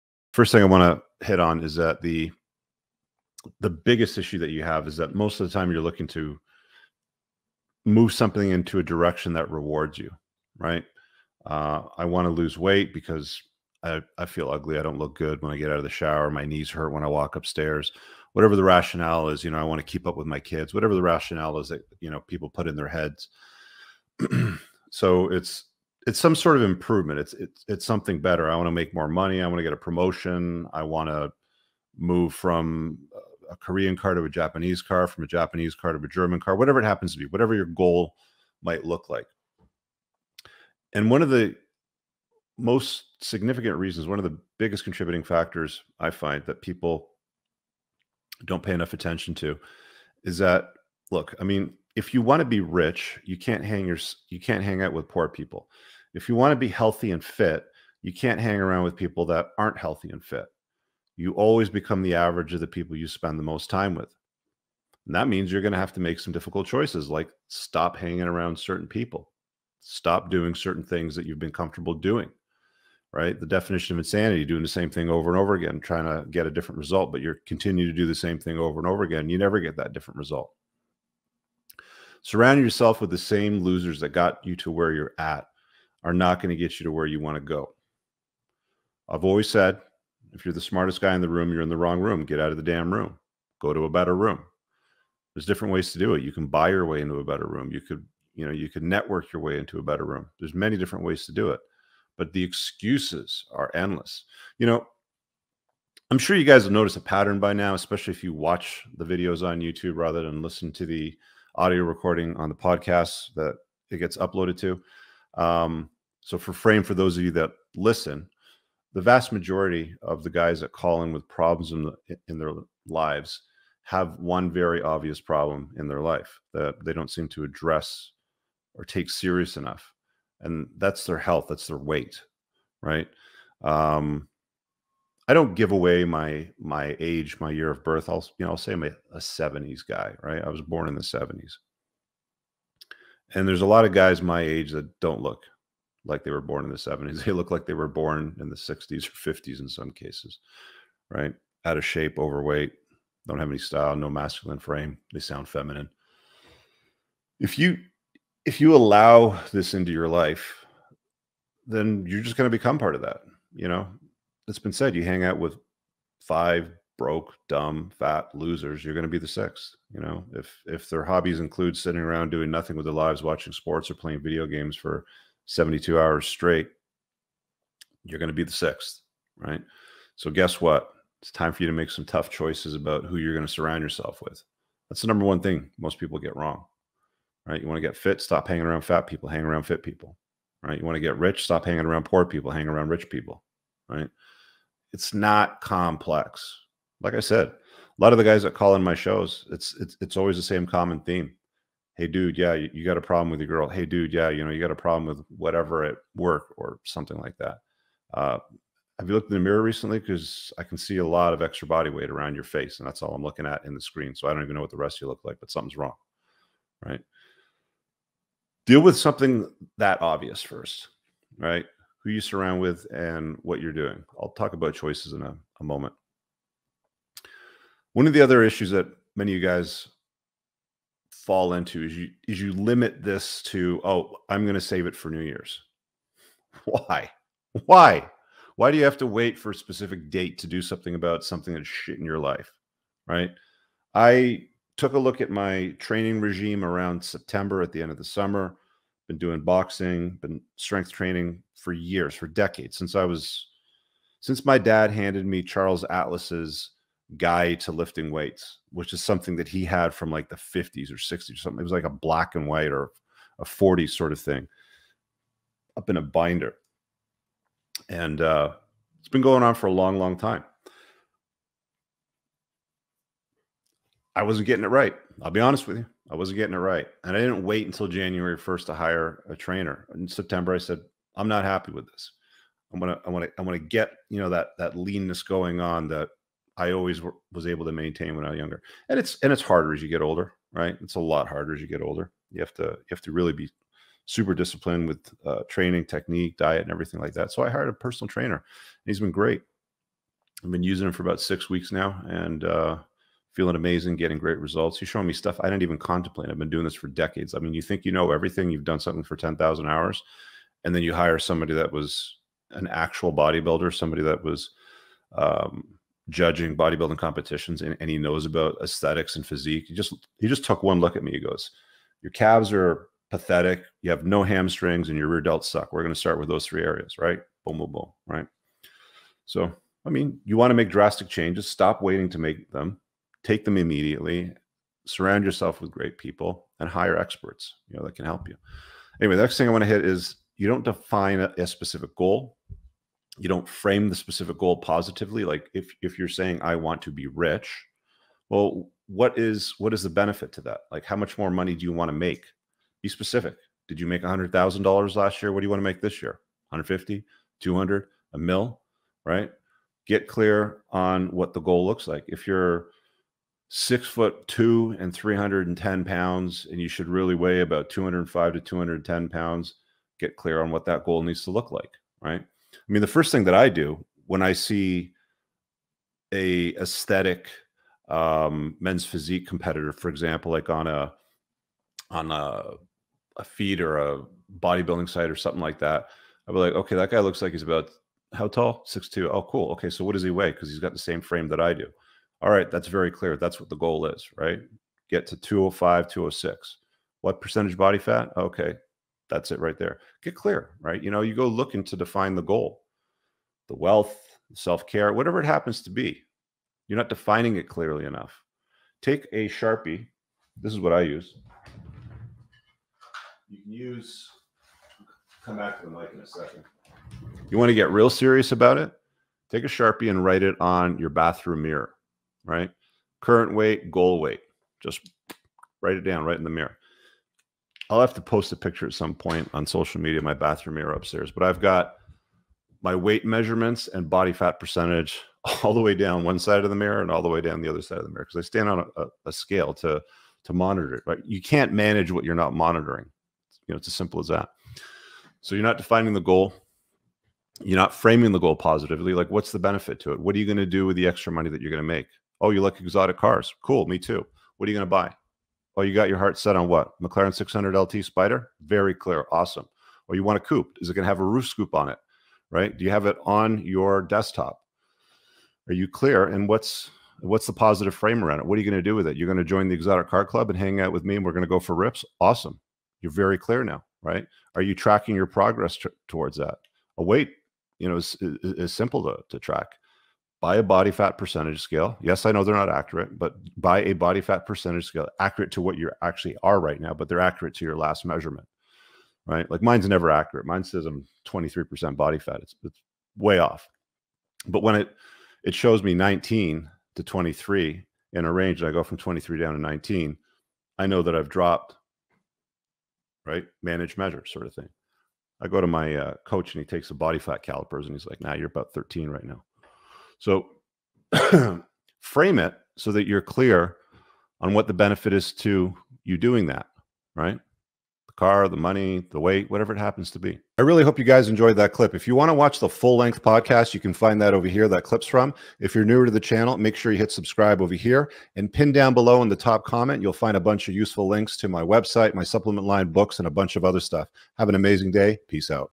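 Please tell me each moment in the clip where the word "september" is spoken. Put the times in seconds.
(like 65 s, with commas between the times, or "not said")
247 s, 280 s.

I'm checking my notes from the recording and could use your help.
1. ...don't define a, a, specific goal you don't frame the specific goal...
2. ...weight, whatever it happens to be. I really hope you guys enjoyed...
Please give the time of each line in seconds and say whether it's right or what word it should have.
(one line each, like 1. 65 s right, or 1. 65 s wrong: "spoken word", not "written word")
1. 340 s right
2. 518 s right.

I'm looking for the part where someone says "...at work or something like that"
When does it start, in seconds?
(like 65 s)
205 s.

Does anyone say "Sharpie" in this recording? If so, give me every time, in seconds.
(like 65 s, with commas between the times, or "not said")
409 s, 419 s.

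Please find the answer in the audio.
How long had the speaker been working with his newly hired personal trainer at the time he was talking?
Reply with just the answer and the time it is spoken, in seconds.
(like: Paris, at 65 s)
about 6 weeks, at 301 s.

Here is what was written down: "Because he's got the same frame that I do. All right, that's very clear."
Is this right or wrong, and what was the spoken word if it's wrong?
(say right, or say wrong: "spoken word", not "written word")
right.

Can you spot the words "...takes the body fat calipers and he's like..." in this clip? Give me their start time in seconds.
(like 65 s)
506 s.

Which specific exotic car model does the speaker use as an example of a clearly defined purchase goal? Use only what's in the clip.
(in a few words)
McLaren 600LT Spider.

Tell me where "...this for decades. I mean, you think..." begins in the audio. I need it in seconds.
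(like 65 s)
306 s.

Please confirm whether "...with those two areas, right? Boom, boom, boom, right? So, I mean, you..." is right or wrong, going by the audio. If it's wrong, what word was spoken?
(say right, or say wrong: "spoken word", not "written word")
wrong: "three", not "two".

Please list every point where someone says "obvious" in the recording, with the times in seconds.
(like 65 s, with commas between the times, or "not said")
124 s, 220 s.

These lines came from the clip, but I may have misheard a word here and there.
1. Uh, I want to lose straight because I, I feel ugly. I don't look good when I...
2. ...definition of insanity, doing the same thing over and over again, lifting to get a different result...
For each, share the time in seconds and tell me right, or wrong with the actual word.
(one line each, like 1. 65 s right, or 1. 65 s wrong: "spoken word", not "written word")
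1. 11 s wrong: "weight", not "straight"
2. 73 s wrong: "trying", not "lifting".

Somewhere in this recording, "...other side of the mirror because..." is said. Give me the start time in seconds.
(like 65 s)
437 s.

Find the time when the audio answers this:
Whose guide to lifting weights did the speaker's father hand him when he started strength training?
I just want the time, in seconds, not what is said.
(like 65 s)
255 s.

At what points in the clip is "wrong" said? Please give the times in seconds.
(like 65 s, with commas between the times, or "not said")
91 s, 186 s, 215 s.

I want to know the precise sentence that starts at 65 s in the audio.
And that means you're going to have to make some difficult choices like stop hanging around certain people.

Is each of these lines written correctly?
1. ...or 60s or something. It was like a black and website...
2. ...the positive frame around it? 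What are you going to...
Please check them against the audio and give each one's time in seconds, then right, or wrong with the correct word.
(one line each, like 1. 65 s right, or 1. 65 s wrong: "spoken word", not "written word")
1. 260 s wrong: "white", not "website"
2. 467 s right.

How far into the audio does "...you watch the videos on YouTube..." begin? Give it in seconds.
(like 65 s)
108 s.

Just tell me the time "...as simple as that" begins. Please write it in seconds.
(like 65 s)
443 s.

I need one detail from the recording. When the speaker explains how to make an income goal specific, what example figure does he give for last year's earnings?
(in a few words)
$100,000.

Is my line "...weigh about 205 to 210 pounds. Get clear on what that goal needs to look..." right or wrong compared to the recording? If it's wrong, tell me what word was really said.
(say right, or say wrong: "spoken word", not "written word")
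right.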